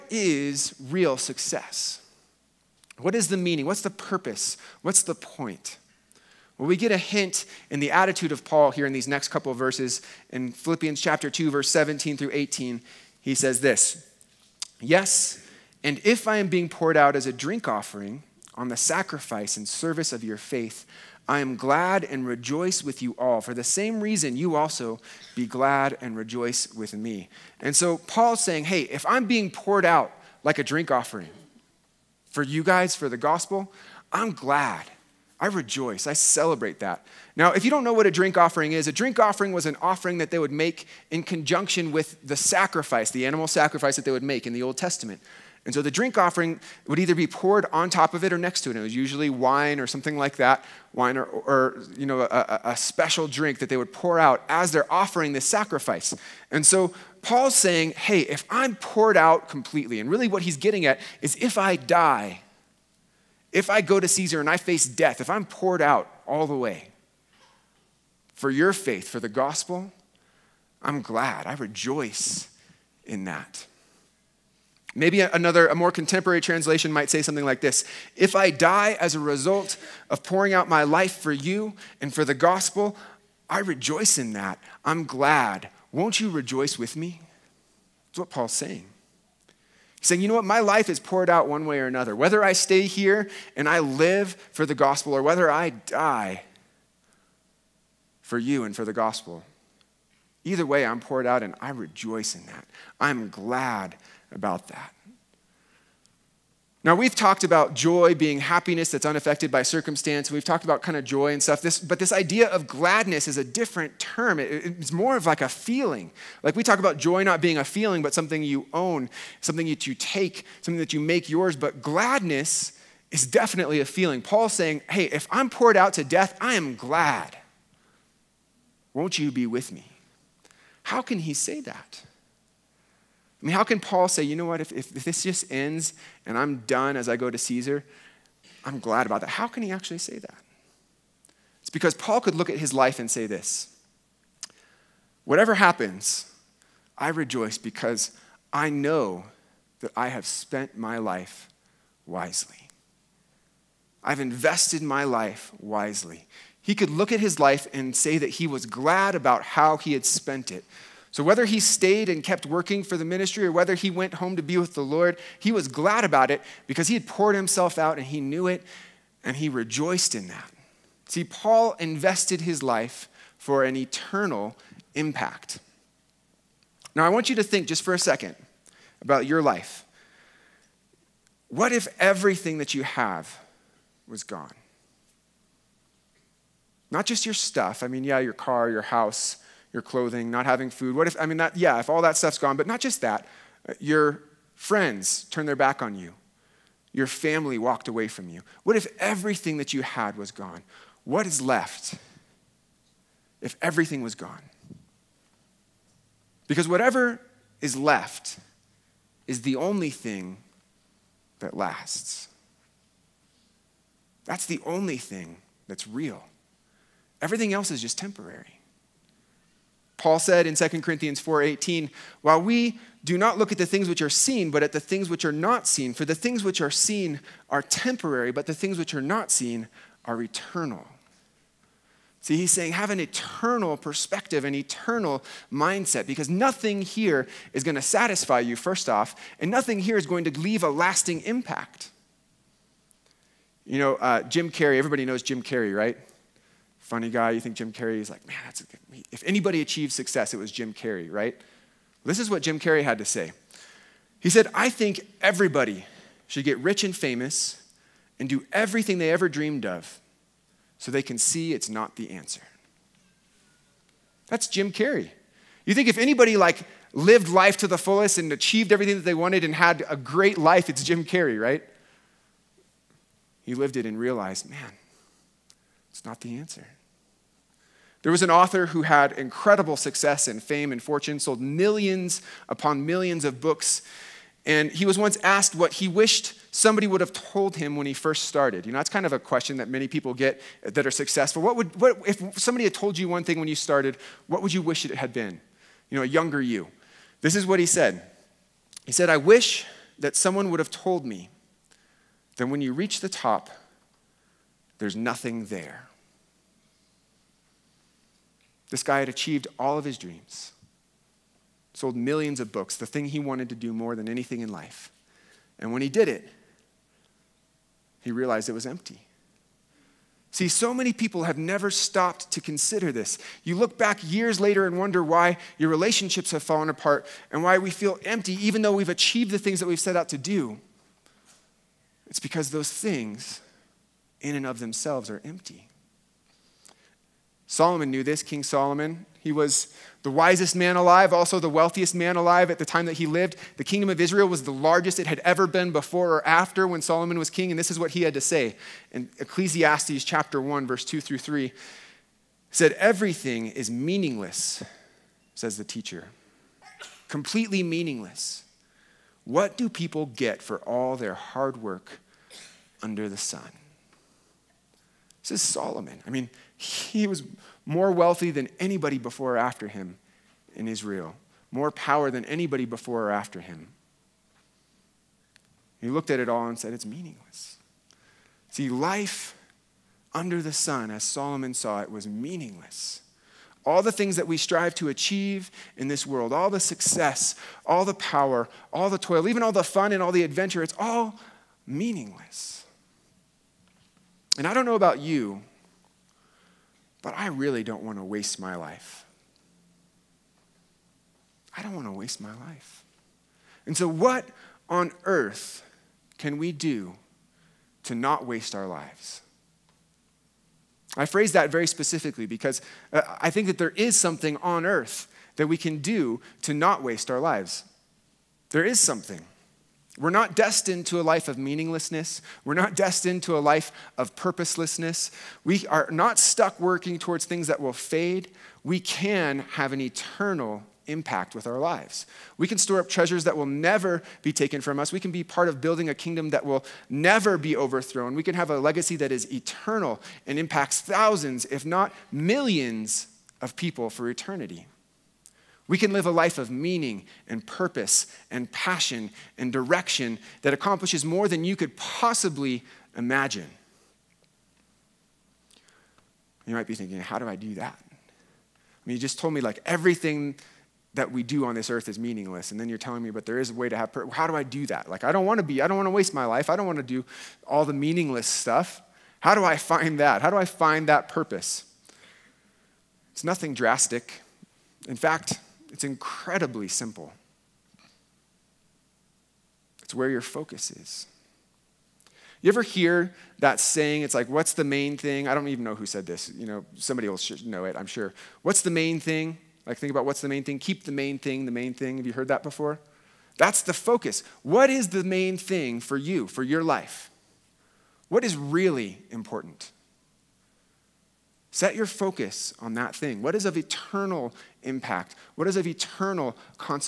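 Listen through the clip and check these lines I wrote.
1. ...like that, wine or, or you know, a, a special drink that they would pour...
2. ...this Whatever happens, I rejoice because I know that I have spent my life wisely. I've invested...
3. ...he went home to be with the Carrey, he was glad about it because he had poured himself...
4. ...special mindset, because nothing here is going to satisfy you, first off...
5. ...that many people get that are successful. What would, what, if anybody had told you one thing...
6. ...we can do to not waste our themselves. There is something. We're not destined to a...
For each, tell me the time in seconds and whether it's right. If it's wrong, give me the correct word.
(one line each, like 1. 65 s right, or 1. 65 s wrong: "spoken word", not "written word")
1. 50 s right
2. 143 s right
3. 163 s wrong: "Lord", not "Carrey"
4. 234 s wrong: "eternal", not "special"
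5. 289 s wrong: "somebody", not "anybody"
6. 415 s wrong: "lives", not "themselves".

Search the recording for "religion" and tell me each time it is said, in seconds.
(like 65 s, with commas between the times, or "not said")
not said.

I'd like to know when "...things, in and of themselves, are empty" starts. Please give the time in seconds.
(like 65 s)
332 s.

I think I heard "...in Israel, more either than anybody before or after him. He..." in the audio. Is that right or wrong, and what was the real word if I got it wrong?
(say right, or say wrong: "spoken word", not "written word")
wrong: "power", not "either".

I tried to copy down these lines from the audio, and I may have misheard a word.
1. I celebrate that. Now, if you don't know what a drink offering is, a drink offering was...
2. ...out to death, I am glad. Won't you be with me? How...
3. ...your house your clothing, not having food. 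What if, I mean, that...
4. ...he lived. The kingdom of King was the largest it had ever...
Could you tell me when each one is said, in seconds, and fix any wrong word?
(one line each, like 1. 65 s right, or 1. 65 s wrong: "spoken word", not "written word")
1. 36 s right
2. 125 s right
3. 188 s right
4. 342 s wrong: "Israel", not "King".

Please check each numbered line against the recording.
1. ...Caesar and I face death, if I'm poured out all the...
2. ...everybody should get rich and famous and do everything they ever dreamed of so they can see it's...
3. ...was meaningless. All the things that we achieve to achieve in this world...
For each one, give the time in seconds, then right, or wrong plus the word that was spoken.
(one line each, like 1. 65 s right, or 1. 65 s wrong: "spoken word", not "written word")
1. 64 s right
2. 255 s right
3. 381 s wrong: "strive", not "achieve".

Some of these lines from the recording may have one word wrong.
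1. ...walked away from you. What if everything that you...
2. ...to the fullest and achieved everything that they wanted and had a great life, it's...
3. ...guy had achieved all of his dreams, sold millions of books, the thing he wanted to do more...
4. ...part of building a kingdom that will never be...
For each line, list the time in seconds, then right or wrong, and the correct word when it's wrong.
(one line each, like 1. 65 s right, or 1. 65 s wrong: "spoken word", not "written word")
1. 197 s right
2. 267 s right
3. 308 s right
4. 435 s right.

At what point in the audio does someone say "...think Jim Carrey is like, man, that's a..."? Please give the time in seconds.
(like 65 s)
247 s.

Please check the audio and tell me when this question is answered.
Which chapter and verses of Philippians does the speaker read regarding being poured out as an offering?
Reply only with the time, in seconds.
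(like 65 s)
11 s.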